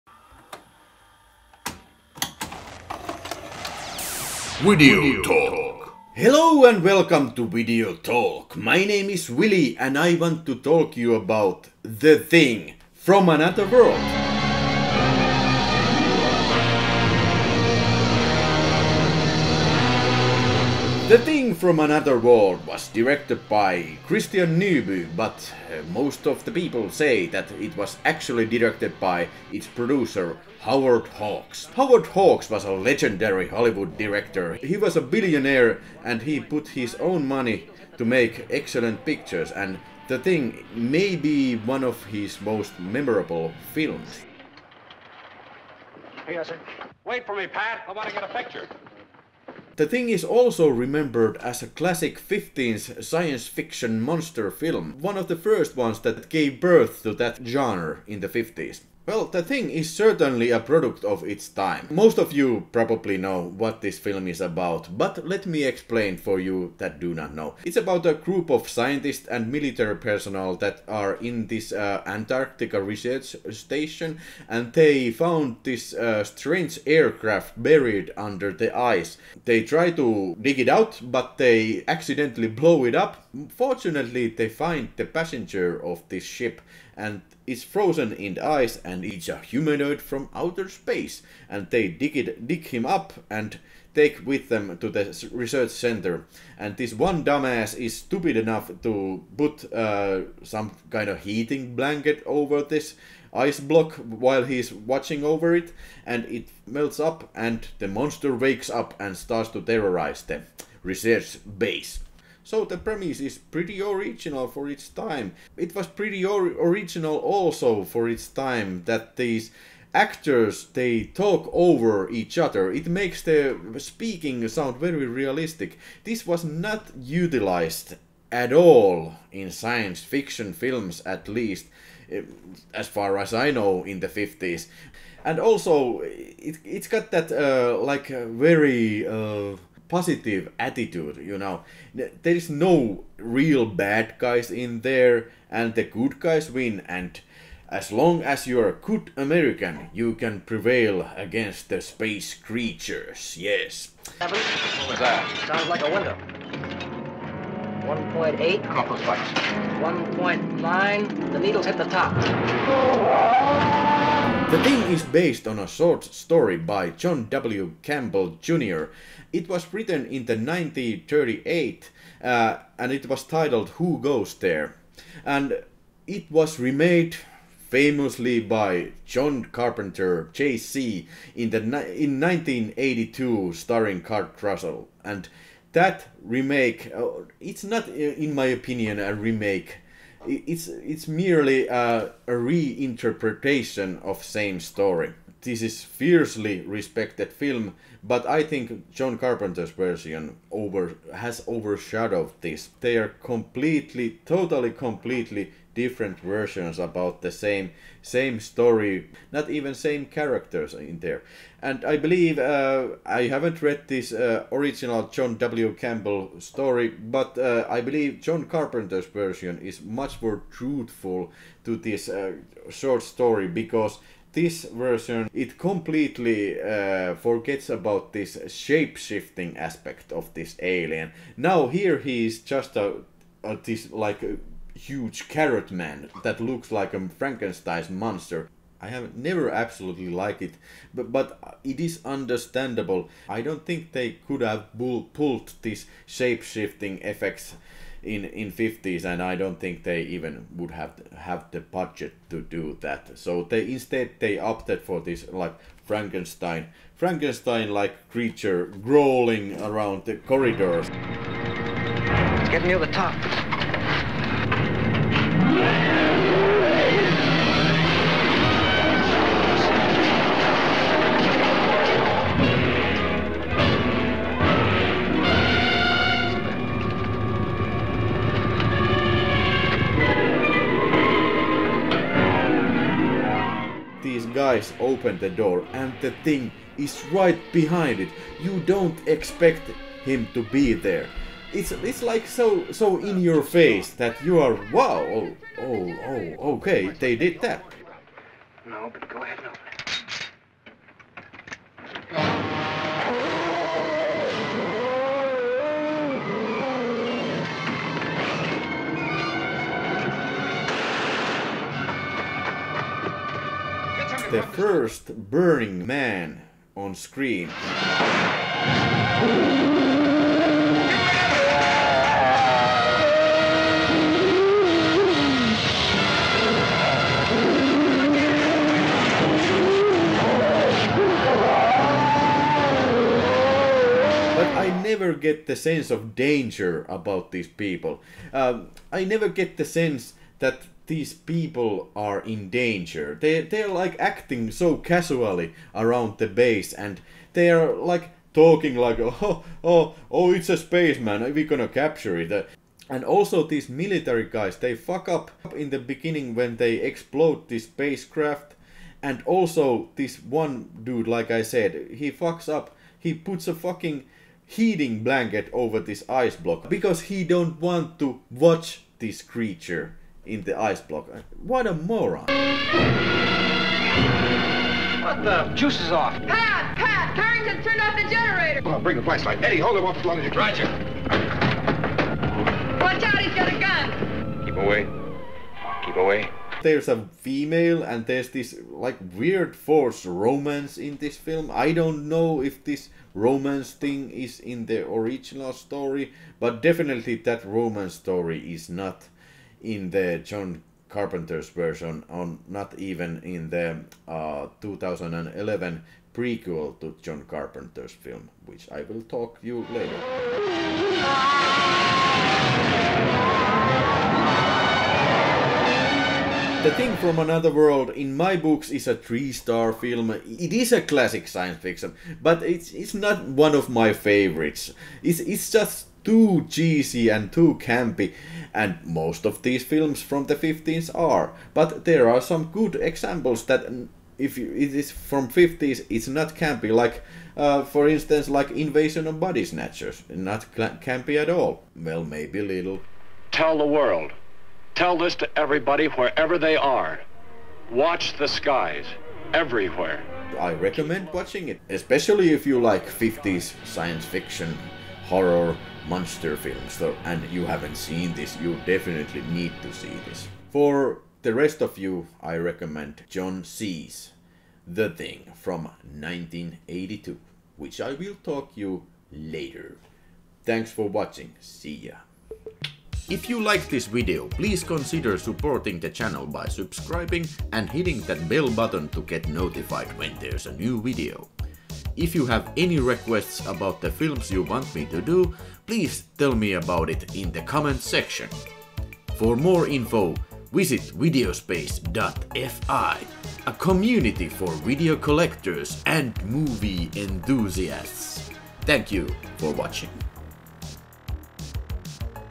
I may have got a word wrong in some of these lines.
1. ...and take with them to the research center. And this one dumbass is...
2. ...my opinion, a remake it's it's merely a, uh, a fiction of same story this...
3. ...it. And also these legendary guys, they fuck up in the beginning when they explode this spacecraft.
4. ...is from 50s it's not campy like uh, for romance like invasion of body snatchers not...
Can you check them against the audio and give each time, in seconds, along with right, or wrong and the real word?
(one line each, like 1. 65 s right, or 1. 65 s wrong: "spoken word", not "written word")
1. 93 s right
2. 188 s wrong: "reinterpretation", not "fiction"
3. 352 s wrong: "military", not "legendary"
4. 434 s wrong: "instance", not "romance".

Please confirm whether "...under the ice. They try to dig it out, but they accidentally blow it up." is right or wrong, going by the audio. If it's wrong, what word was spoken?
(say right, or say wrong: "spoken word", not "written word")
right.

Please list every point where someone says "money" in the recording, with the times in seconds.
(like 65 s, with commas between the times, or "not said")
37 s.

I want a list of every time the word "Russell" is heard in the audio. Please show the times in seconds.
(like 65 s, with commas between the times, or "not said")
184 s.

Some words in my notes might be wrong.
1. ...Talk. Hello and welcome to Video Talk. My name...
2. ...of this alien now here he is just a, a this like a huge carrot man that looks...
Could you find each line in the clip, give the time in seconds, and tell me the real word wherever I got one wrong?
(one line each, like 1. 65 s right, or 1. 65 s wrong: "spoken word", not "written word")
1. 5 s right
2. 230 s right.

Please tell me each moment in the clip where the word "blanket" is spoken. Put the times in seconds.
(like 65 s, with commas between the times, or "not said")
101 s, 365 s.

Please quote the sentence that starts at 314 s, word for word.
the first Burning Man on screen.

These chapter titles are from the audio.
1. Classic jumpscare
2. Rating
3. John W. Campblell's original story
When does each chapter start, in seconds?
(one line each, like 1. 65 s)
1. 260 s
2. 380 s
3. 152 s.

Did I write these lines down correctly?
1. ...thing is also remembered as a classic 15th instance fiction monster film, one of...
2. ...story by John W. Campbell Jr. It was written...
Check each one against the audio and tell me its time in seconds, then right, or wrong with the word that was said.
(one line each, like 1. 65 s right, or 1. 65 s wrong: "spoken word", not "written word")
1. 49 s wrong: "science", not "instance"
2. 166 s right.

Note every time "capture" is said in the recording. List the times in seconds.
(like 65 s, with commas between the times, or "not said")
351 s.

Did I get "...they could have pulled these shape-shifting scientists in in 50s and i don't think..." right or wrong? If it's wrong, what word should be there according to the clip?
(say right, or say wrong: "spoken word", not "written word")
wrong: "effects", not "scientists".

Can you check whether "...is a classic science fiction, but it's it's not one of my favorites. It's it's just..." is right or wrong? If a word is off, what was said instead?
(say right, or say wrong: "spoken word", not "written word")
right.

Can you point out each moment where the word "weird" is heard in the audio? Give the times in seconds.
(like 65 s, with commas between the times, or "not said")
389 s.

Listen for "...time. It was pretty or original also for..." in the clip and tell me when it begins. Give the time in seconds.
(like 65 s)
114 s.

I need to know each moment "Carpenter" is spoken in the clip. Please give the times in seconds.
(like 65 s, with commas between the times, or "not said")
179 s, 199 s, 218 s, 400 s, 407 s.